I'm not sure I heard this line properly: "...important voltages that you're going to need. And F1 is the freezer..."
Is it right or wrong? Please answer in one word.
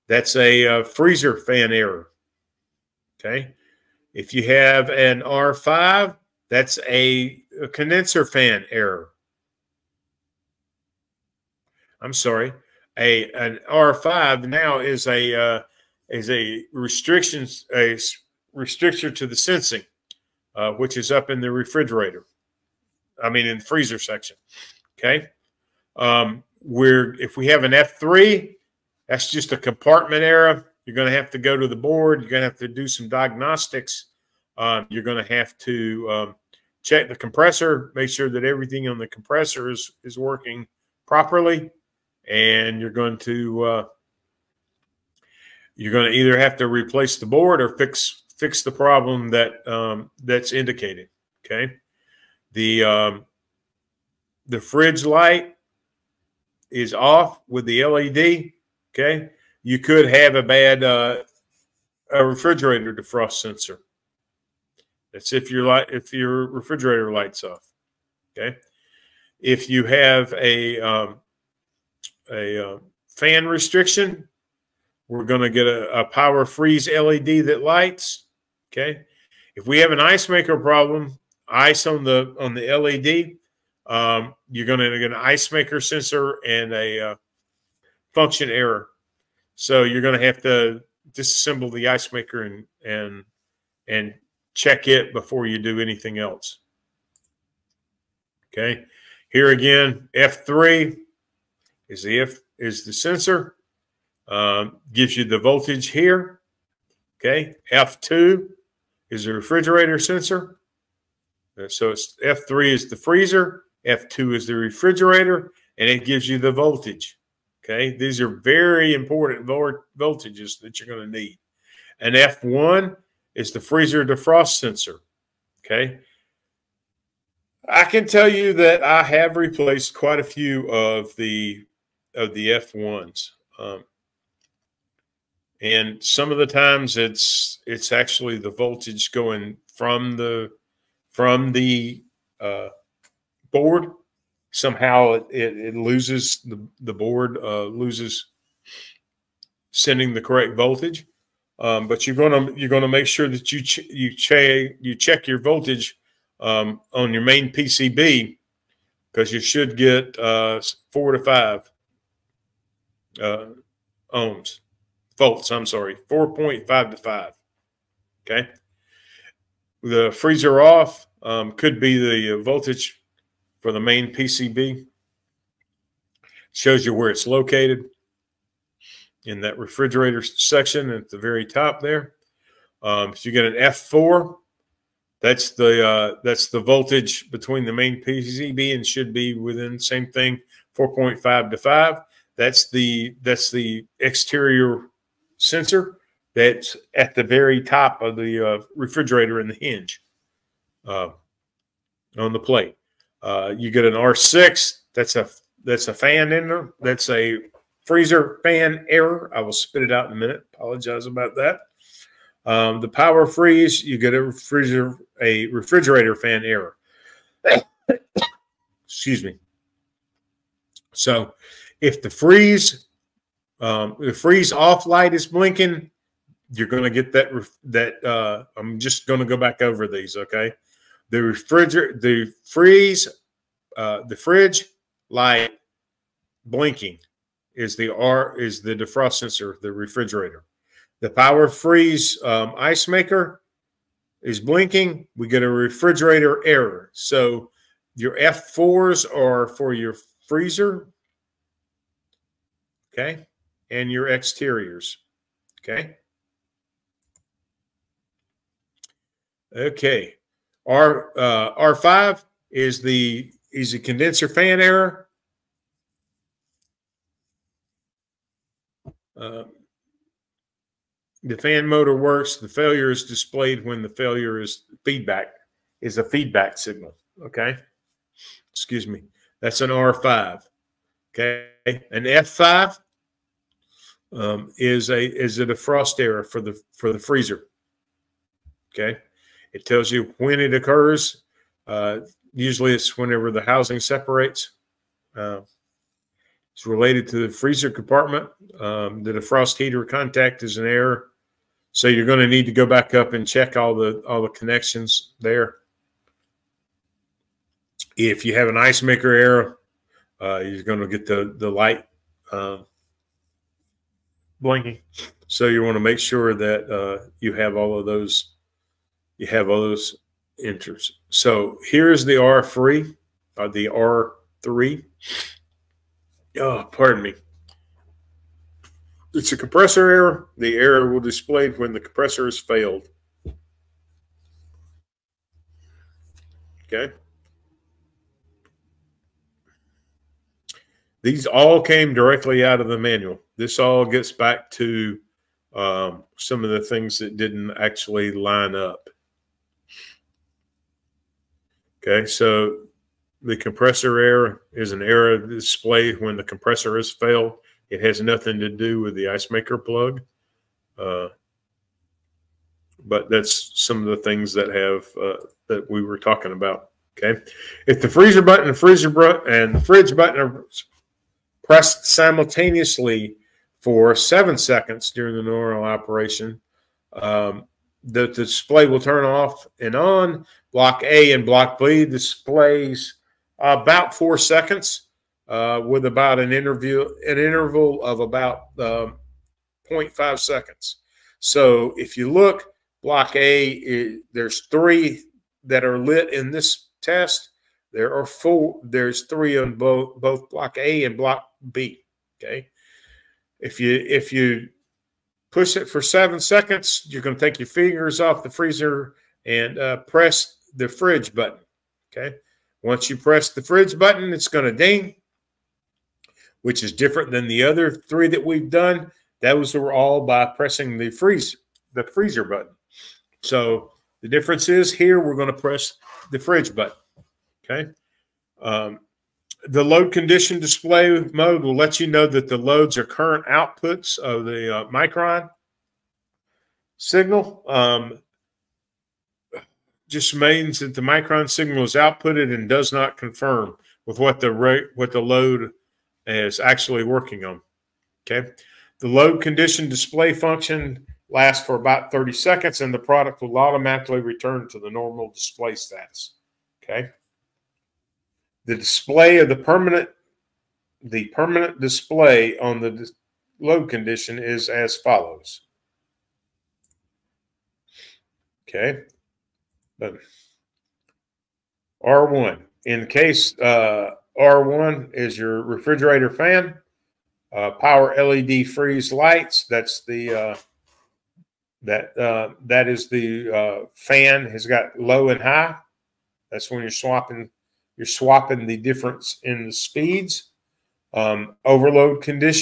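right.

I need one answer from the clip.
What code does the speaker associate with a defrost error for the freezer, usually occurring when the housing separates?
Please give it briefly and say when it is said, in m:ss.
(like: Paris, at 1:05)
F5, at 4:42.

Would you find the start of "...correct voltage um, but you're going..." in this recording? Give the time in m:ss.
2:30.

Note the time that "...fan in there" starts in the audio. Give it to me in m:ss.
3:25.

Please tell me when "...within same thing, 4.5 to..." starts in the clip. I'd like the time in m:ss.
3:09.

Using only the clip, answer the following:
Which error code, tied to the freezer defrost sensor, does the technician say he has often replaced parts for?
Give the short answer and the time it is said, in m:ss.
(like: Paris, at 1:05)
F1, at 2:12.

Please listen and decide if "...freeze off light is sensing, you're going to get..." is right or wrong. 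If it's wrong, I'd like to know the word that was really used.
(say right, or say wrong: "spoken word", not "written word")
wrong: "blinking", not "sensing".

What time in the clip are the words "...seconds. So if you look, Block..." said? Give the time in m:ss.
6:30.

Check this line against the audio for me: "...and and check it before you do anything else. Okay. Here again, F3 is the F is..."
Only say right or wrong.
right.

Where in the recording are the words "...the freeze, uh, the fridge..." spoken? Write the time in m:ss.
3:51.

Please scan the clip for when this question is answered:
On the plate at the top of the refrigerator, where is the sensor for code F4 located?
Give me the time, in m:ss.
3:19.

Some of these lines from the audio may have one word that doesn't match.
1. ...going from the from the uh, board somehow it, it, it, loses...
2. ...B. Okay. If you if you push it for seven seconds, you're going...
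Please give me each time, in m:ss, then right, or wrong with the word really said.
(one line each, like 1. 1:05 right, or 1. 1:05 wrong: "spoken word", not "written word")
1. 2:19 right
2. 6:41 right.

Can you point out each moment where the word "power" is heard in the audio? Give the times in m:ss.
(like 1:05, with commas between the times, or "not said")
1:16, 3:32, 4:01, 7:57.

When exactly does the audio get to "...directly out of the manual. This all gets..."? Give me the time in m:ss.
5:41.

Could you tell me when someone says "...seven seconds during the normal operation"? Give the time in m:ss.
6:13.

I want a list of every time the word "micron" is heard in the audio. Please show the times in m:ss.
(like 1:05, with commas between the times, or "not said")
7:14, 7:20.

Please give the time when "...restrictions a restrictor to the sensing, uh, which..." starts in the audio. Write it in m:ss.
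0:16.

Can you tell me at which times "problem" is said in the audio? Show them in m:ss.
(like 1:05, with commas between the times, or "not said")
0:48, 1:20.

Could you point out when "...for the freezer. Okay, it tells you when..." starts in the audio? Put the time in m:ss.
4:46.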